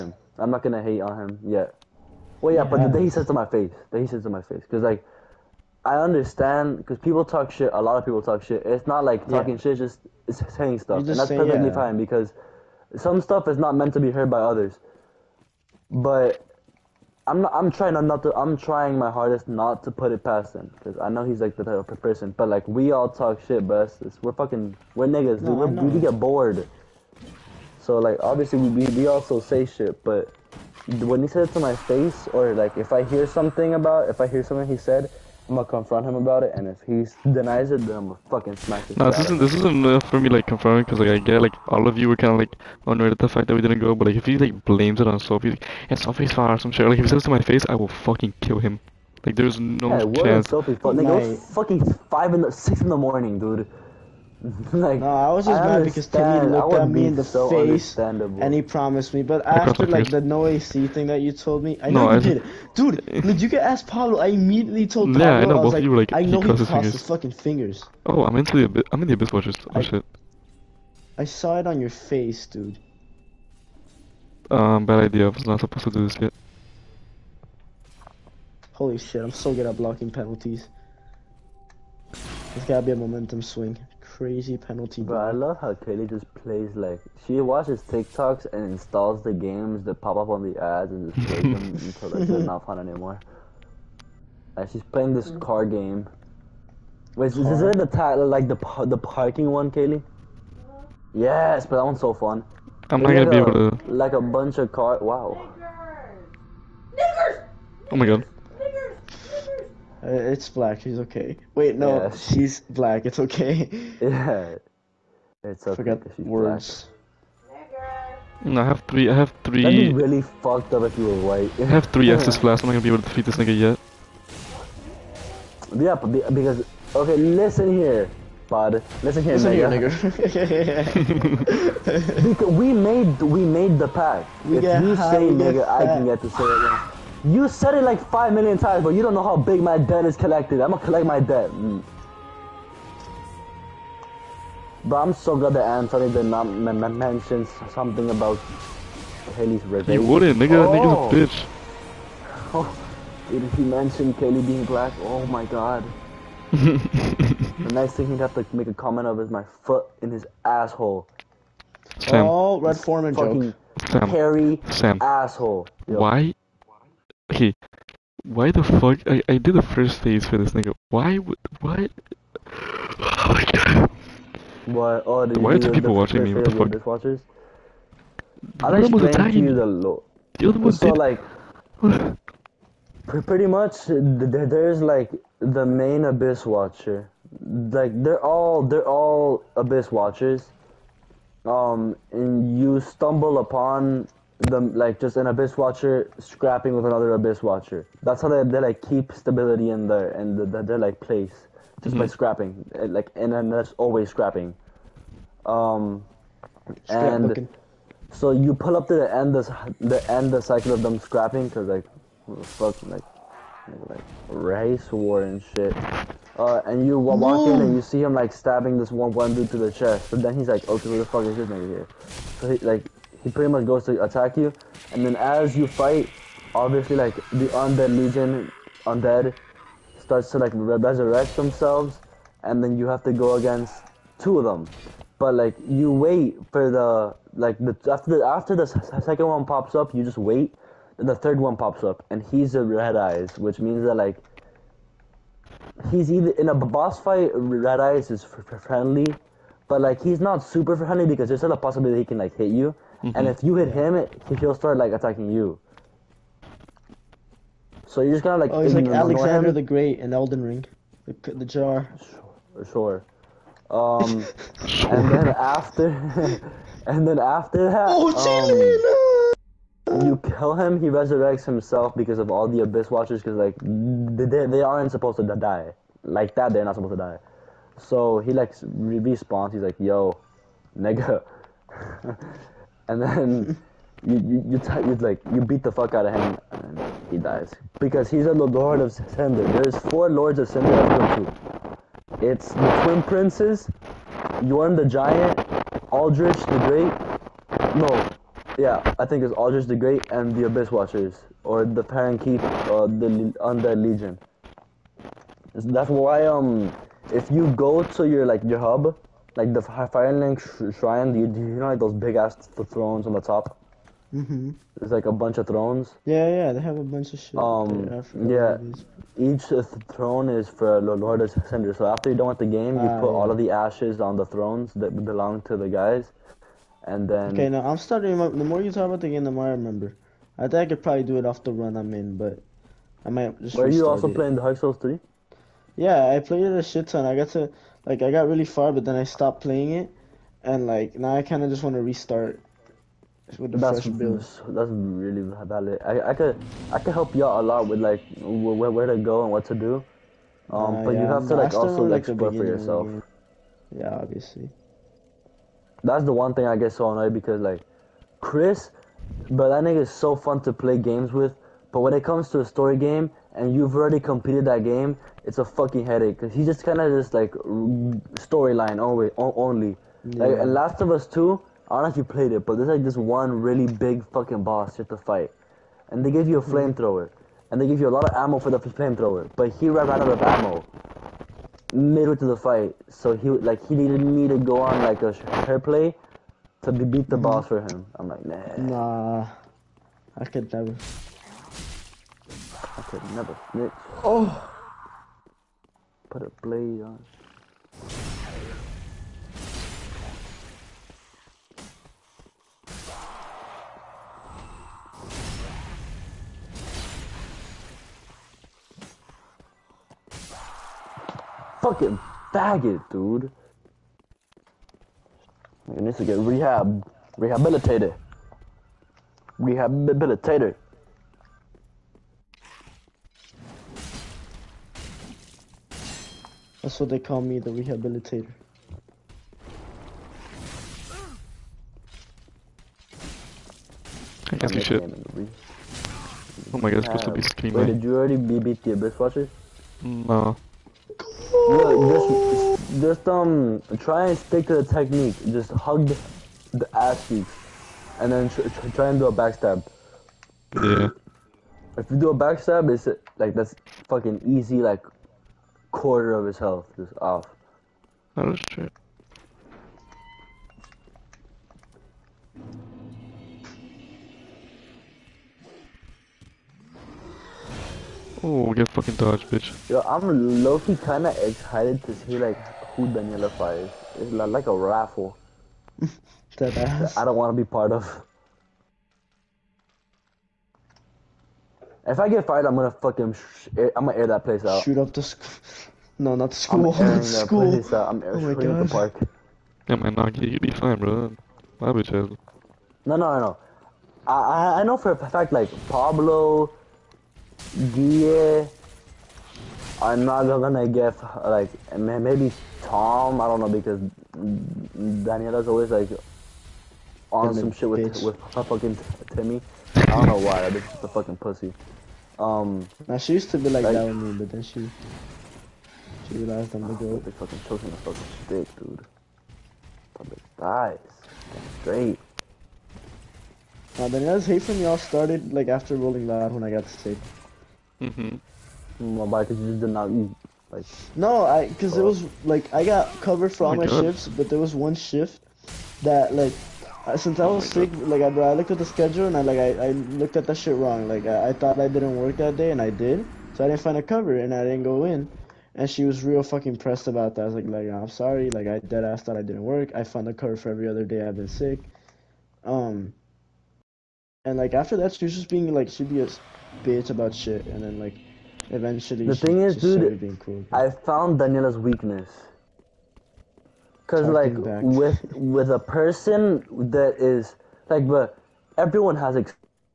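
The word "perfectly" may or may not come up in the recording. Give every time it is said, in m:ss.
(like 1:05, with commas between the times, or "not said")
0:11.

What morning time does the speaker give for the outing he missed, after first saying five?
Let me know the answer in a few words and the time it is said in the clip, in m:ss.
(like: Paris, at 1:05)
6, at 0:52.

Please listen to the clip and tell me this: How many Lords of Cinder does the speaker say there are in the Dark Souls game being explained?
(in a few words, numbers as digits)
4.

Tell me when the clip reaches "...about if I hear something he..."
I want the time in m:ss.
0:33.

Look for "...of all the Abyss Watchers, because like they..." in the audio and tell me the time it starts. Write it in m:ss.
4:32.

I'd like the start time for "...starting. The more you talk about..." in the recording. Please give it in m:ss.
5:27.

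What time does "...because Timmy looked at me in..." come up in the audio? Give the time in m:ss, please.
0:55.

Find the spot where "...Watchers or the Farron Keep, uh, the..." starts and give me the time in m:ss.
5:00.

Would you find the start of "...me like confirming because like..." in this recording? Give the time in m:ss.
0:40.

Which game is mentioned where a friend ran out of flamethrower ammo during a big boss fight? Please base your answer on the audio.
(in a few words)
Last of Us Two.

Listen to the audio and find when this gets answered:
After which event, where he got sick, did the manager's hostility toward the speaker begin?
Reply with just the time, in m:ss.
8:45.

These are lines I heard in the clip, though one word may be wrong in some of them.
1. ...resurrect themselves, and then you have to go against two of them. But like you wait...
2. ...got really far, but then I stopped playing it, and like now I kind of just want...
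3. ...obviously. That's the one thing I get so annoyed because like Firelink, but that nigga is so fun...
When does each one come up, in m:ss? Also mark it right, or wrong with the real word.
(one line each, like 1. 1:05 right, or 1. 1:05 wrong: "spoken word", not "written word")
1. 3:50 right
2. 5:38 right
3. 5:54 wrong: "Chris", not "Firelink".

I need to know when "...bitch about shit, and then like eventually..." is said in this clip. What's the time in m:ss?
9:16.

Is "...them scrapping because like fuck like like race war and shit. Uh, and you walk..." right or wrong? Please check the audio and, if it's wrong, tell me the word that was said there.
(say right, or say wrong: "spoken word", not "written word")
right.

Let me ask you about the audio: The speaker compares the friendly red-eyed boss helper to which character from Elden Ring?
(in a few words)
Alexander.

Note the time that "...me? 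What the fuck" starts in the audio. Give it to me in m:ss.
2:56.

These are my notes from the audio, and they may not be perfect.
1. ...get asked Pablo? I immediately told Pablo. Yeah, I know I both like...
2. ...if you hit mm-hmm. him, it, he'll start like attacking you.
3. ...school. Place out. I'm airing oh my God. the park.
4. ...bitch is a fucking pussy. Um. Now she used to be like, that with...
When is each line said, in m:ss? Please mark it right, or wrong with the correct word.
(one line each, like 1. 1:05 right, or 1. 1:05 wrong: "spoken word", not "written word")
1. 1:03 right
2. 4:13 right
3. 8:07 right
4. 8:30 right.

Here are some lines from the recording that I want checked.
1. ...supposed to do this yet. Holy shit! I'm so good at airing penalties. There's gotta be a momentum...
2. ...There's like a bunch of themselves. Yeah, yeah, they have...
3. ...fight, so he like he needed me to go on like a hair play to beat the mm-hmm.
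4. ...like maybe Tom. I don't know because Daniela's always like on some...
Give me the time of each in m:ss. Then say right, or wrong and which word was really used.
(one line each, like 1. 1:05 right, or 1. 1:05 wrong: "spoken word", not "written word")
1. 1:15 wrong: "blocking", not "airing"
2. 5:14 wrong: "thrones", not "themselves"
3. 6:22 right
4. 8:21 right.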